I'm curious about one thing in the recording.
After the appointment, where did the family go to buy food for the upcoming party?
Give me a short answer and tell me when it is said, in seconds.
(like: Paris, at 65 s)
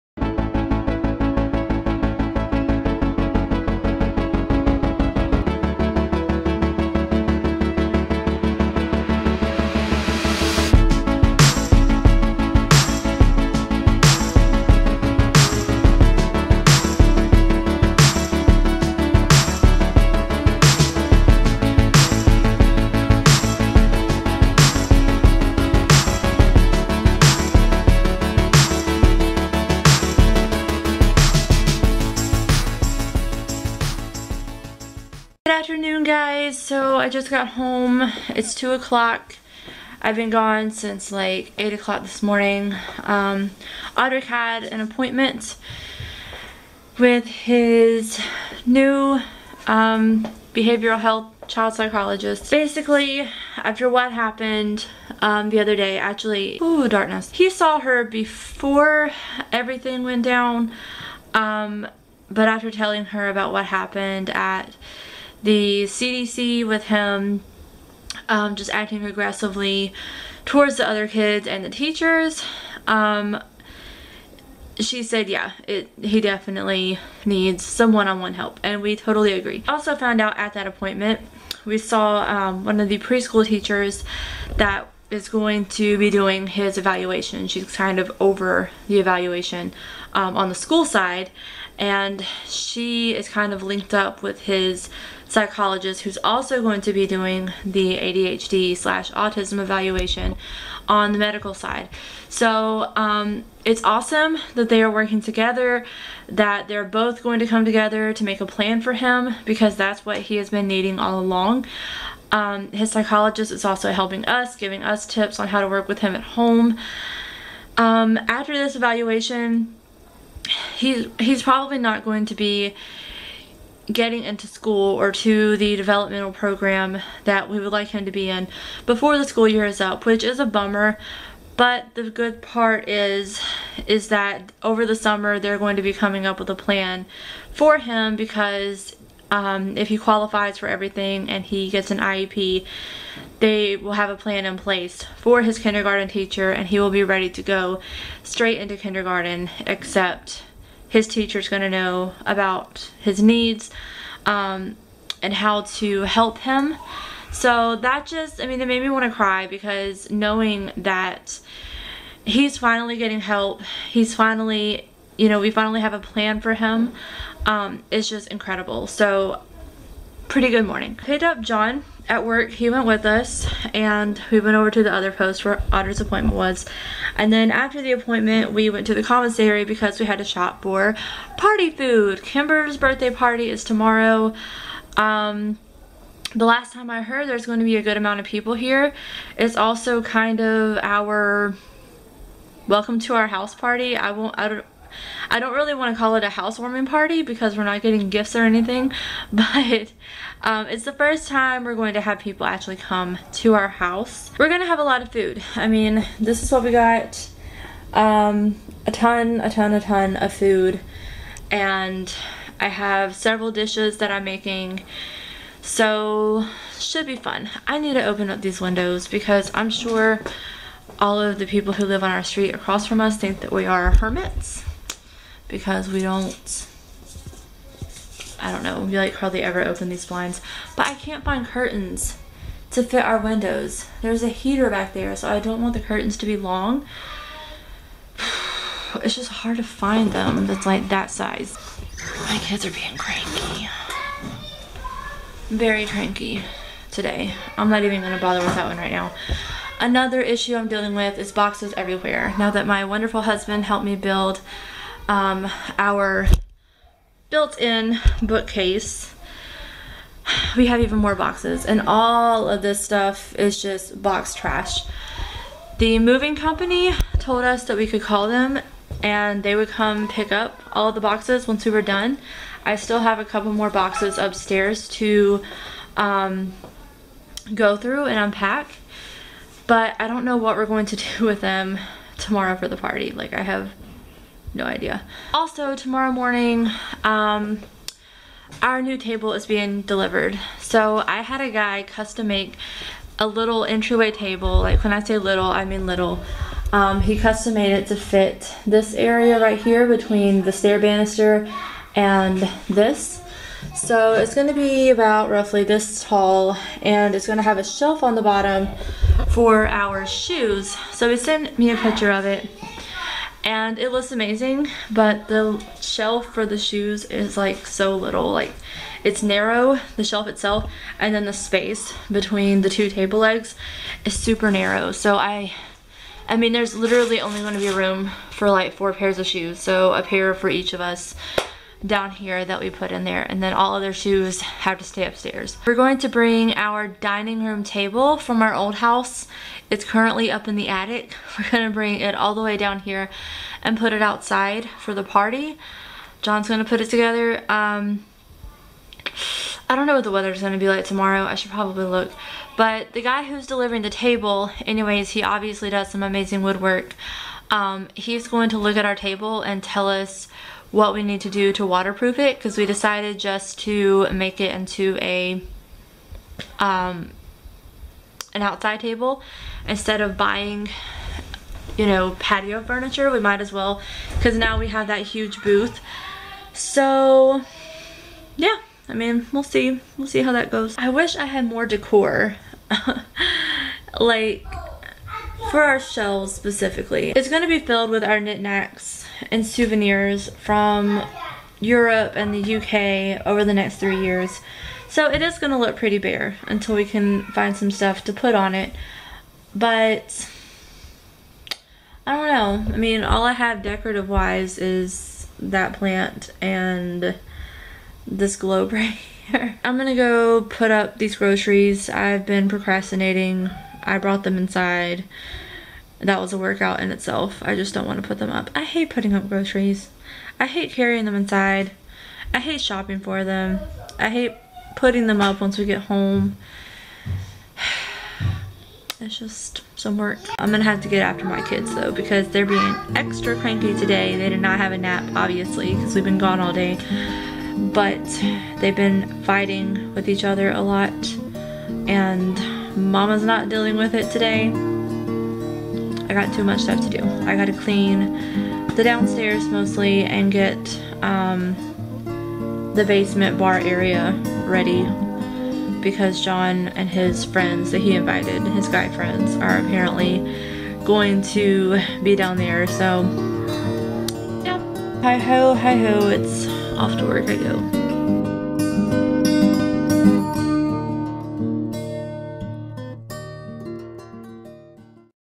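commissary, at 179 s.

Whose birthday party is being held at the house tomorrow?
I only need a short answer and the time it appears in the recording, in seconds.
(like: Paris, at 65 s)
Kimber, at 182 s.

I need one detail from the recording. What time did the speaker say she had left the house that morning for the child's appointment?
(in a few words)
8 o'clock.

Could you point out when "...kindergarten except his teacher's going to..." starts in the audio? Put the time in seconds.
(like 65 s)
148 s.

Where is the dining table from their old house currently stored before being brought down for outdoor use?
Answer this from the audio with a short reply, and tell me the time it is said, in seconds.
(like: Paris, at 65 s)
the attic, at 340 s.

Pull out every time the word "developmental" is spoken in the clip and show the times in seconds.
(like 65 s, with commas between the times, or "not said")
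125 s.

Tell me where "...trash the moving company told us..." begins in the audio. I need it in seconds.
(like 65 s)
264 s.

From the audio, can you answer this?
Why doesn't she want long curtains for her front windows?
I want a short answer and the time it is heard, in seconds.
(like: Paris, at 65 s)
There's a heater, at 234 s.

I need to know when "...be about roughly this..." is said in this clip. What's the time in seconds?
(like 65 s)
304 s.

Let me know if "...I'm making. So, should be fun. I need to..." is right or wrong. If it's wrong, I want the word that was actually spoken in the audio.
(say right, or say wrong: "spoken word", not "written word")
right.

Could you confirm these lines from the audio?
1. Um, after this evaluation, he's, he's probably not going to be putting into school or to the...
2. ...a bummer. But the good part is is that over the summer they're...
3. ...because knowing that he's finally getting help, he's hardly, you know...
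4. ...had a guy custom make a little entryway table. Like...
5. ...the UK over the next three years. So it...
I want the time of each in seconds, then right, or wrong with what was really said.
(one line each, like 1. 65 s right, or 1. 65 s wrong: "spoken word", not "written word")
1. 117 s wrong: "getting", not "putting"
2. 130 s right
3. 159 s wrong: "finally", not "hardly"
4. 291 s right
5. 392 s right.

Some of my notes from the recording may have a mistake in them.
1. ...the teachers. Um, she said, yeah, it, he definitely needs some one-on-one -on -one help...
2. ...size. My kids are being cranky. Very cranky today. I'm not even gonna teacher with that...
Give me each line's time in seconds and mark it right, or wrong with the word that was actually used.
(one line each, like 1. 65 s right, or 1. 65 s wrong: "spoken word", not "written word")
1. 71 s right
2. 241 s wrong: "bother", not "teacher".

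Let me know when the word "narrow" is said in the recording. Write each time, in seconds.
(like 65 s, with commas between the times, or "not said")
319 s, 324 s.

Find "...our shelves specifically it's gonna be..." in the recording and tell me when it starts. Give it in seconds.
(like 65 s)
385 s.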